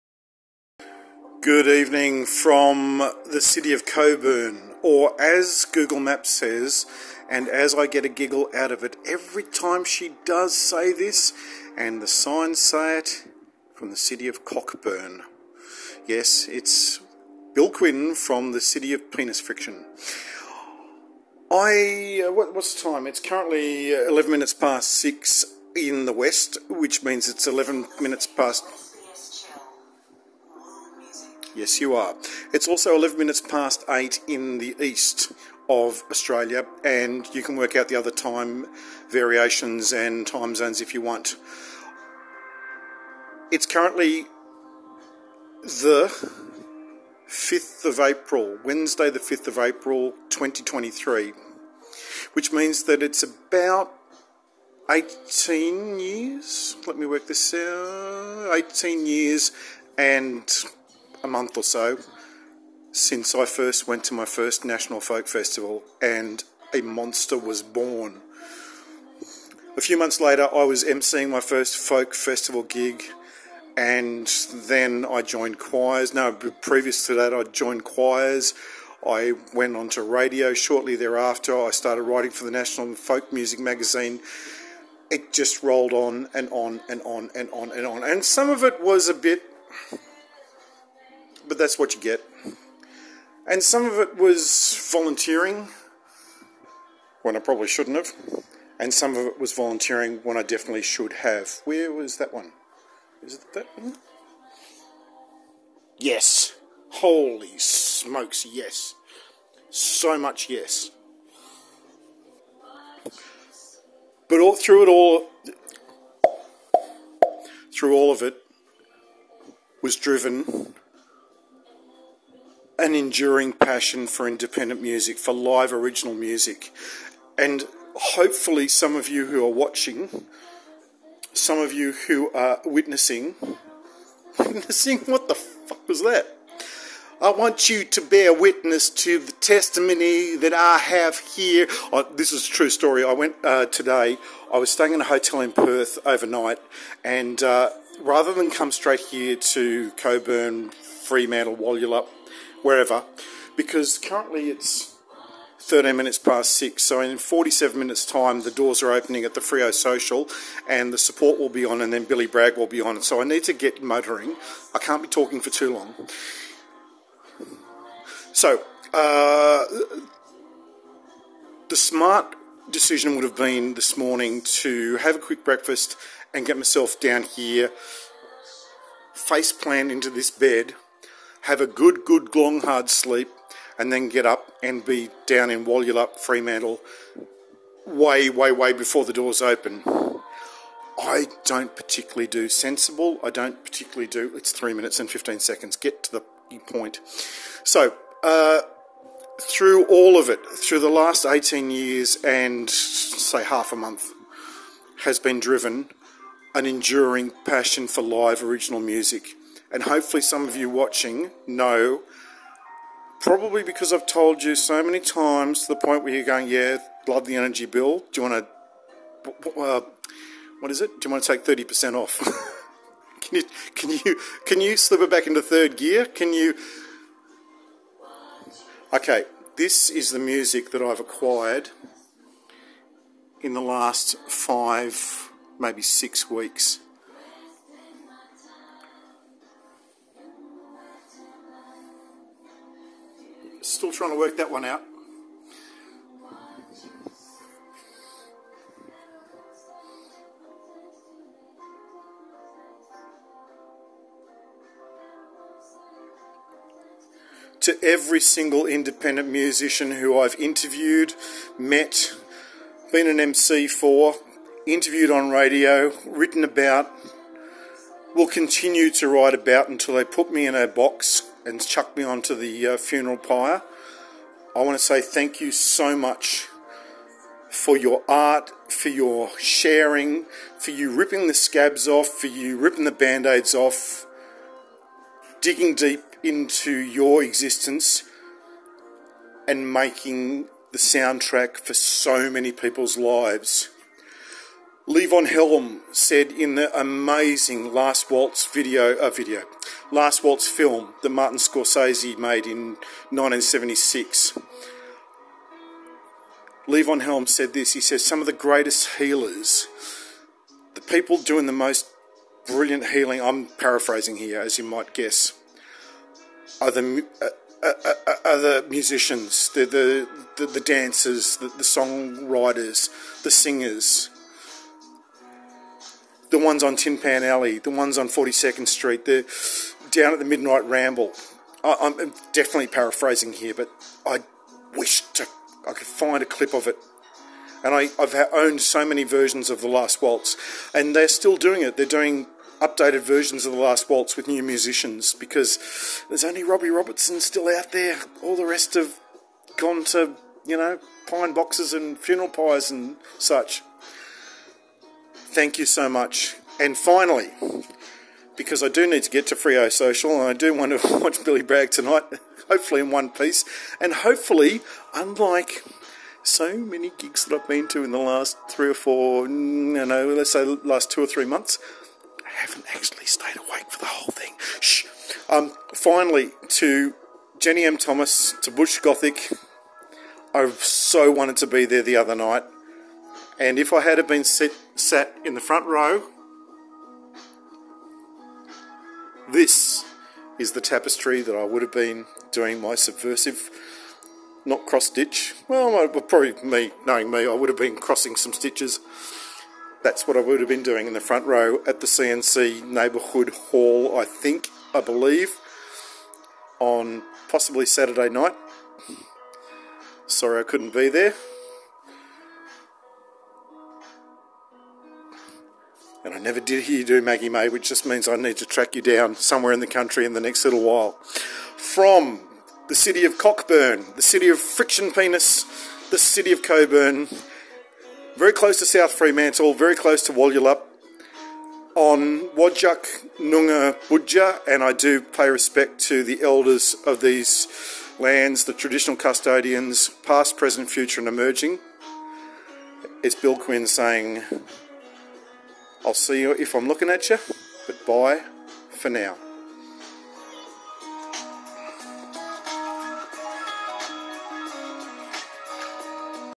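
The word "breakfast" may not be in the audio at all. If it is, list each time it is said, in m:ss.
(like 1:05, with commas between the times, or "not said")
2:55.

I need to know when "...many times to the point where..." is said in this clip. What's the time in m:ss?
3:34.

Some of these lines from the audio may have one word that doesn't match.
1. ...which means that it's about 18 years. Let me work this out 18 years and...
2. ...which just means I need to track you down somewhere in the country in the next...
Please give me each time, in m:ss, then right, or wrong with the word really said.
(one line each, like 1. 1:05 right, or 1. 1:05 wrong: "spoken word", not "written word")
1. 0:52 right
2. 6:57 right.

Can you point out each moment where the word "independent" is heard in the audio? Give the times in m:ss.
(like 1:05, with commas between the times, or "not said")
2:04, 4:18.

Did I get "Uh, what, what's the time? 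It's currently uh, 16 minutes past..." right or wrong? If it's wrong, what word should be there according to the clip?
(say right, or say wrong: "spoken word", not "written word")
wrong: "11", not "16".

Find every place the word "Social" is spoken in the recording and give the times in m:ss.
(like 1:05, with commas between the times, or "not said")
2:39, 5:59.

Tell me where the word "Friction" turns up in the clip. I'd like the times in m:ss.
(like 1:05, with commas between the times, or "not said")
0:19, 7:04.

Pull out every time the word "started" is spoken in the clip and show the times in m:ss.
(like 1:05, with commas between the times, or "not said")
1:21.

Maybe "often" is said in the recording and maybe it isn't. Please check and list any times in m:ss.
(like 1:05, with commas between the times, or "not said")
not said.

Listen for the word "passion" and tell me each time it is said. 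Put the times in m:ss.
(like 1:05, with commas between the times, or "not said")
2:03, 3:27.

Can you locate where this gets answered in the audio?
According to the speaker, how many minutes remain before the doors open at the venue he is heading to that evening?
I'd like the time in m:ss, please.
2:37.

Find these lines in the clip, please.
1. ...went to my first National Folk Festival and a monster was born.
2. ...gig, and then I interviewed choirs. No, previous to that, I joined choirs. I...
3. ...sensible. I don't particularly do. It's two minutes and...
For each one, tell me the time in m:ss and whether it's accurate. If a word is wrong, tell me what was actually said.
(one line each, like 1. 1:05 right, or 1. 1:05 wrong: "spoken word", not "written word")
1. 1:03 right
2. 1:12 wrong: "joined", not "interviewed"
3. 3:12 wrong: "three", not "two".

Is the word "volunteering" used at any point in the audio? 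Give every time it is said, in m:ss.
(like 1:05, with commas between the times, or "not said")
1:34, 1:39.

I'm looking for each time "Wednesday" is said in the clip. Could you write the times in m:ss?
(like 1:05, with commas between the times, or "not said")
0:48.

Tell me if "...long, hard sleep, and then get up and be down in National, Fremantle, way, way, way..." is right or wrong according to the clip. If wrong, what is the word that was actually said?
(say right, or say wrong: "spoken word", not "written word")
wrong: "Walyalup", not "National".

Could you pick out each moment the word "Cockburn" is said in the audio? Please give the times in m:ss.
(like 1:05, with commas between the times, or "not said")
0:14, 7:03.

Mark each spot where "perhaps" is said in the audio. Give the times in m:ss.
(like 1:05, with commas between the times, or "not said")
not said.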